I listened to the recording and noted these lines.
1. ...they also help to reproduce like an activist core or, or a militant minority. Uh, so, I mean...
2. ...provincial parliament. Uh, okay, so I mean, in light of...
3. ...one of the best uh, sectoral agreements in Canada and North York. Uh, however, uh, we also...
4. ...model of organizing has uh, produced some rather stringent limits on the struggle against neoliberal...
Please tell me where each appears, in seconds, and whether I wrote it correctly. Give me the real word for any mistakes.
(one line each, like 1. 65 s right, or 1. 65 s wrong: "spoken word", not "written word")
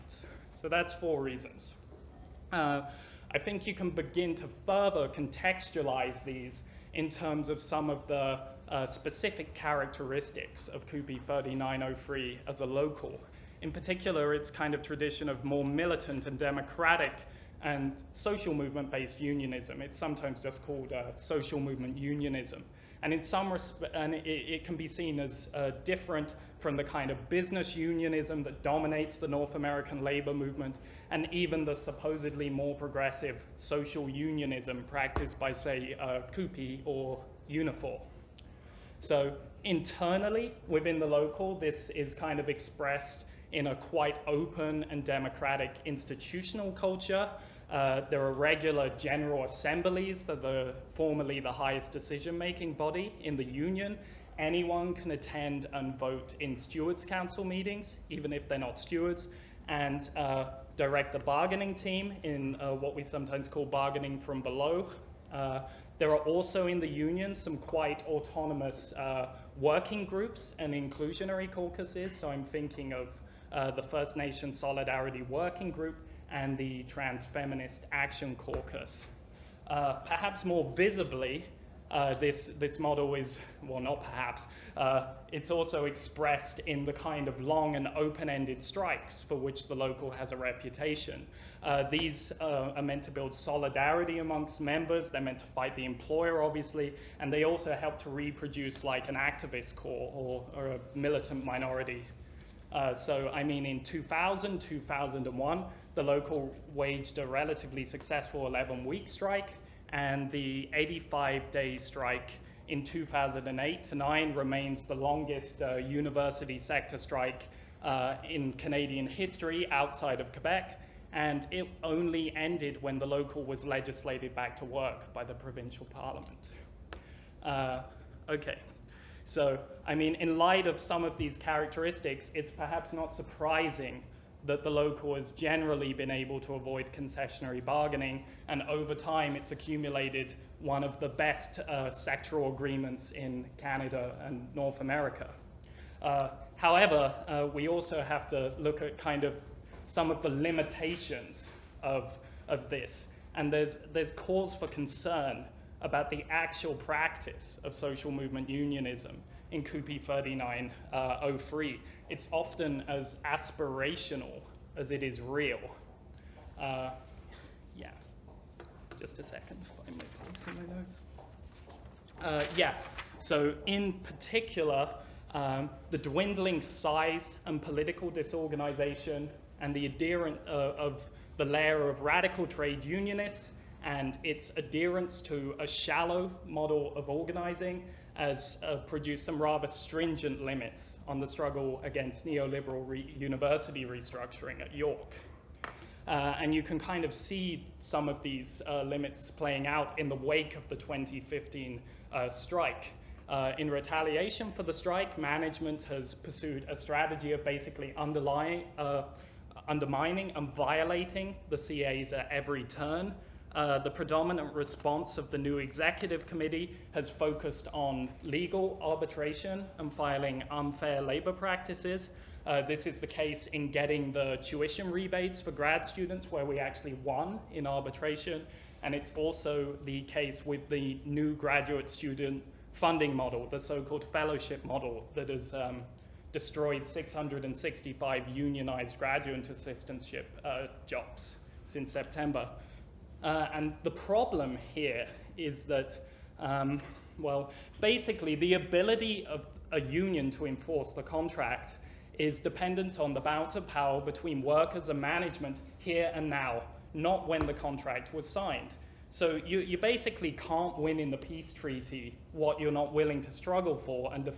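1. 97 s right
2. 125 s right
3. 140 s wrong: "America", not "York"
4. 186 s right.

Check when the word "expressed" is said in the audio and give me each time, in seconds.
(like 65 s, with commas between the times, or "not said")
42 s, 85 s.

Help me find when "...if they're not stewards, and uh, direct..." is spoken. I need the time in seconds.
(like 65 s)
58 s.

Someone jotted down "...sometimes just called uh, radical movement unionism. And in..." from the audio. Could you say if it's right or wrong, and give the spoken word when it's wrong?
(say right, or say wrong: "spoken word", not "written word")
wrong: "social", not "radical".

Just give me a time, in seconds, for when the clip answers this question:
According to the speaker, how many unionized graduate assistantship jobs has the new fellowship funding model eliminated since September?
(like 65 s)
236 s.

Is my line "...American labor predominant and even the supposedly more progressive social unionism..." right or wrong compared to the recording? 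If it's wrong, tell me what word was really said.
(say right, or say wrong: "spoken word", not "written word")
wrong: "movement", not "predominant".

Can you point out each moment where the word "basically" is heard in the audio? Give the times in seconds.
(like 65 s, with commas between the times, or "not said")
207 s, 247 s, 259 s.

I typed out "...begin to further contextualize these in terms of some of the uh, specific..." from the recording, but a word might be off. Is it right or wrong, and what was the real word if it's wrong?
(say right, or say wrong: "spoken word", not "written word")
right.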